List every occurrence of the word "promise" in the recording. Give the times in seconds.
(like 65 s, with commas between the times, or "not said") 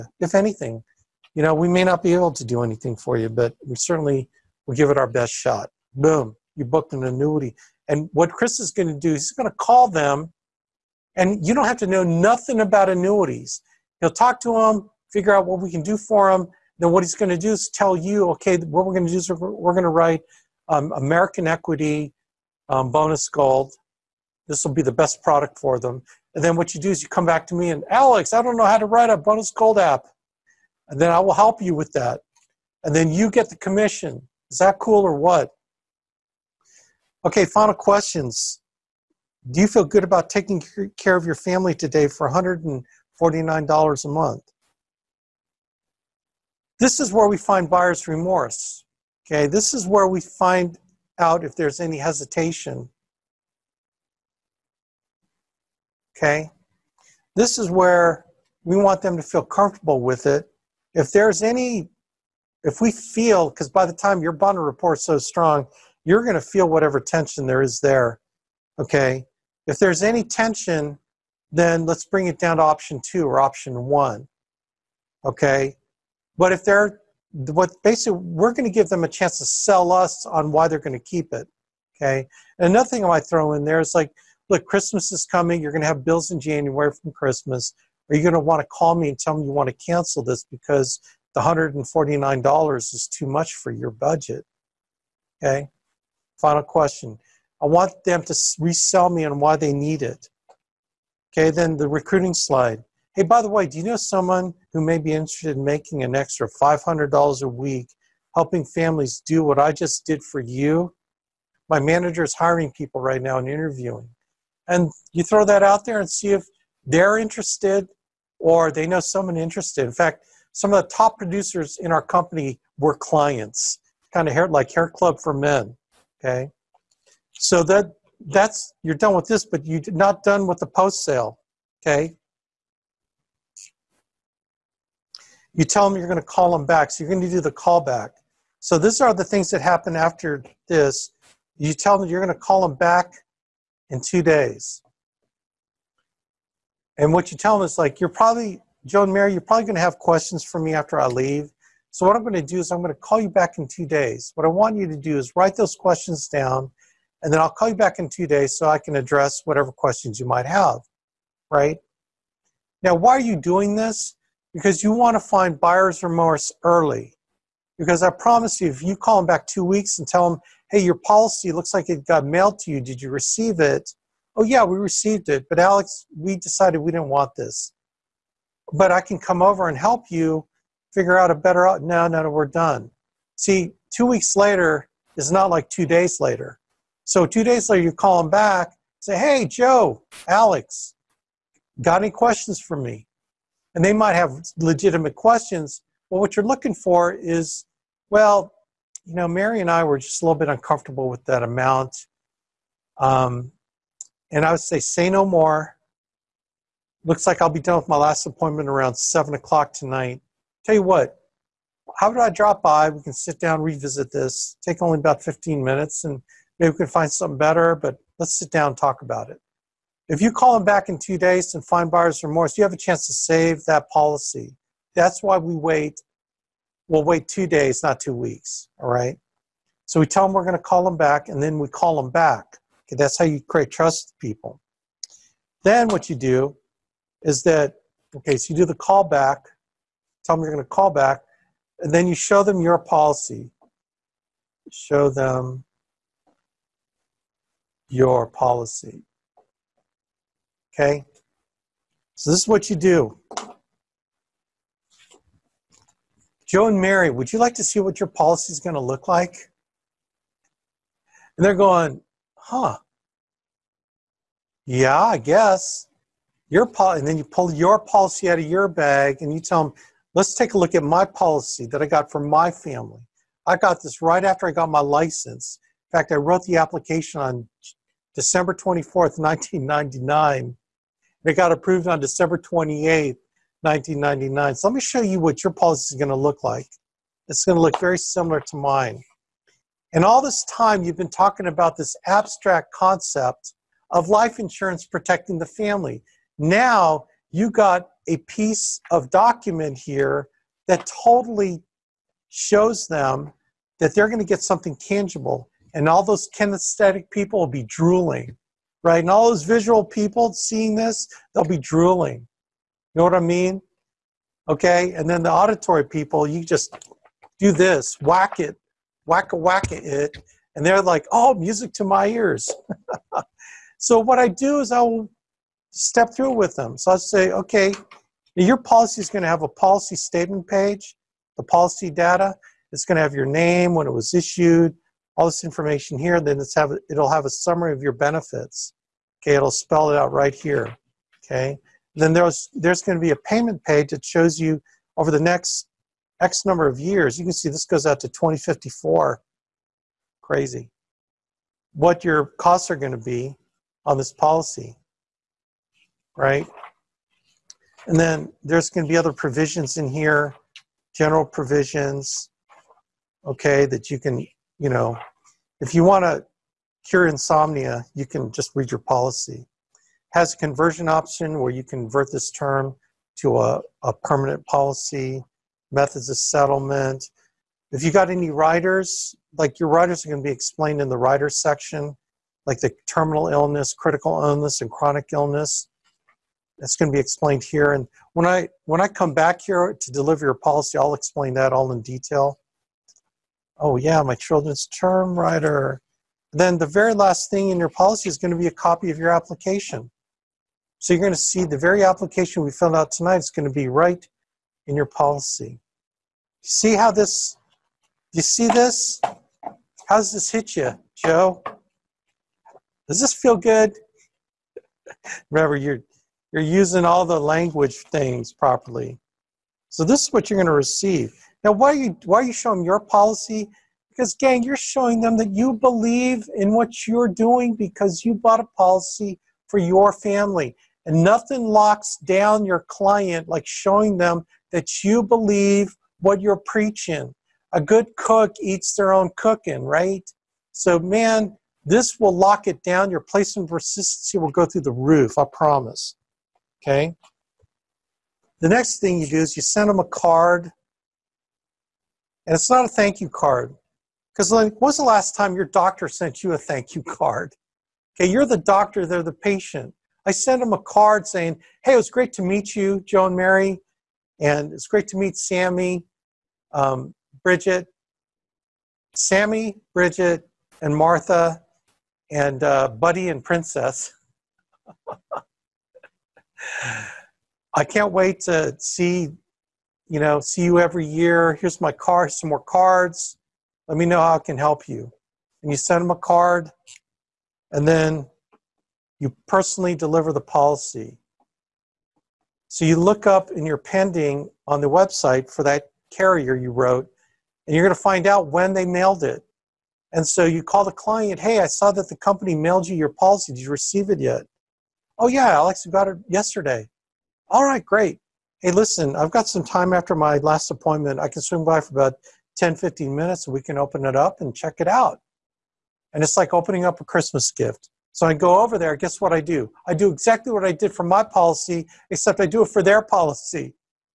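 168 s, 445 s.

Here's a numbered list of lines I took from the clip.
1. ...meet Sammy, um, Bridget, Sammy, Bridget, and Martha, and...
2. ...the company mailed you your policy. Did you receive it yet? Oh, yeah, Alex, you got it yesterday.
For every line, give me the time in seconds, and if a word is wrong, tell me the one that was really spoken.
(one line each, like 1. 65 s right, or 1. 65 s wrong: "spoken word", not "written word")
1. 464 s right
2. 501 s right.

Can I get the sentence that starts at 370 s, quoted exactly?
Has a conversion option where you convert this term to a, a permanent policy, methods of settlement.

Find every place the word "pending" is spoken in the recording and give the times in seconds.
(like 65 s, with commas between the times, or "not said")
493 s.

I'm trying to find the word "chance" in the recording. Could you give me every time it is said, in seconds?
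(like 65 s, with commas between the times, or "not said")
79 s, 222 s.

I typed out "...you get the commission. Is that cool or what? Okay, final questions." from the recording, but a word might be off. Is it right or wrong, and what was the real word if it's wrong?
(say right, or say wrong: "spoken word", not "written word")
right.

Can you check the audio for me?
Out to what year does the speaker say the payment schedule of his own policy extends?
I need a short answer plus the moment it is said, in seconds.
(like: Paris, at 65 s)
2054, at 348 s.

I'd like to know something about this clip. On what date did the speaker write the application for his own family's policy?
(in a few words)
December 24, 1999.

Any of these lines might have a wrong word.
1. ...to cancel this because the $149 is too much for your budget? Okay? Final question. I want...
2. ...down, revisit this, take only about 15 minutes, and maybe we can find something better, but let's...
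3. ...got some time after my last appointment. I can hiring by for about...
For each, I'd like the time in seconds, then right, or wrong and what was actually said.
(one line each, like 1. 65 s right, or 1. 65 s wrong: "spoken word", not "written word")
1. 89 s right
2. 213 s right
3. 509 s wrong: "swing", not "hiring".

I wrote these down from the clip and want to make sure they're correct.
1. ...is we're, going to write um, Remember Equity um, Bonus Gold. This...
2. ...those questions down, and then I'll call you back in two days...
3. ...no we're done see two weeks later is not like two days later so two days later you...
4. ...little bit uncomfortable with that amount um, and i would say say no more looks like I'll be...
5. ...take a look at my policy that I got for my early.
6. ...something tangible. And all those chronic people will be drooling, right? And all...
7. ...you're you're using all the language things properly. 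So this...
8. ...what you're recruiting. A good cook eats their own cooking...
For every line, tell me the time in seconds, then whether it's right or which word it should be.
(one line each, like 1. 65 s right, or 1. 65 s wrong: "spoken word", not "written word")
1. 19 s wrong: "American", not "Remember"
2. 155 s right
3. 182 s right
4. 200 s right
5. 270 s wrong: "family", not "early"
6. 304 s wrong: "kinesthetic", not "chronic"
7. 415 s right
8. 436 s wrong: "preaching", not "recruiting".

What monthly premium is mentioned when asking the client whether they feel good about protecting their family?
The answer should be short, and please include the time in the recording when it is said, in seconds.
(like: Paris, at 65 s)
$149, at 42 s.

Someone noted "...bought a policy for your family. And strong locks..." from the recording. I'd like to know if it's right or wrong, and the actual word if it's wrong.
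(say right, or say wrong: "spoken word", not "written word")
wrong: "nothing", not "strong".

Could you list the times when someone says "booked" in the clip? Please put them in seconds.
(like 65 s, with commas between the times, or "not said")
6 s.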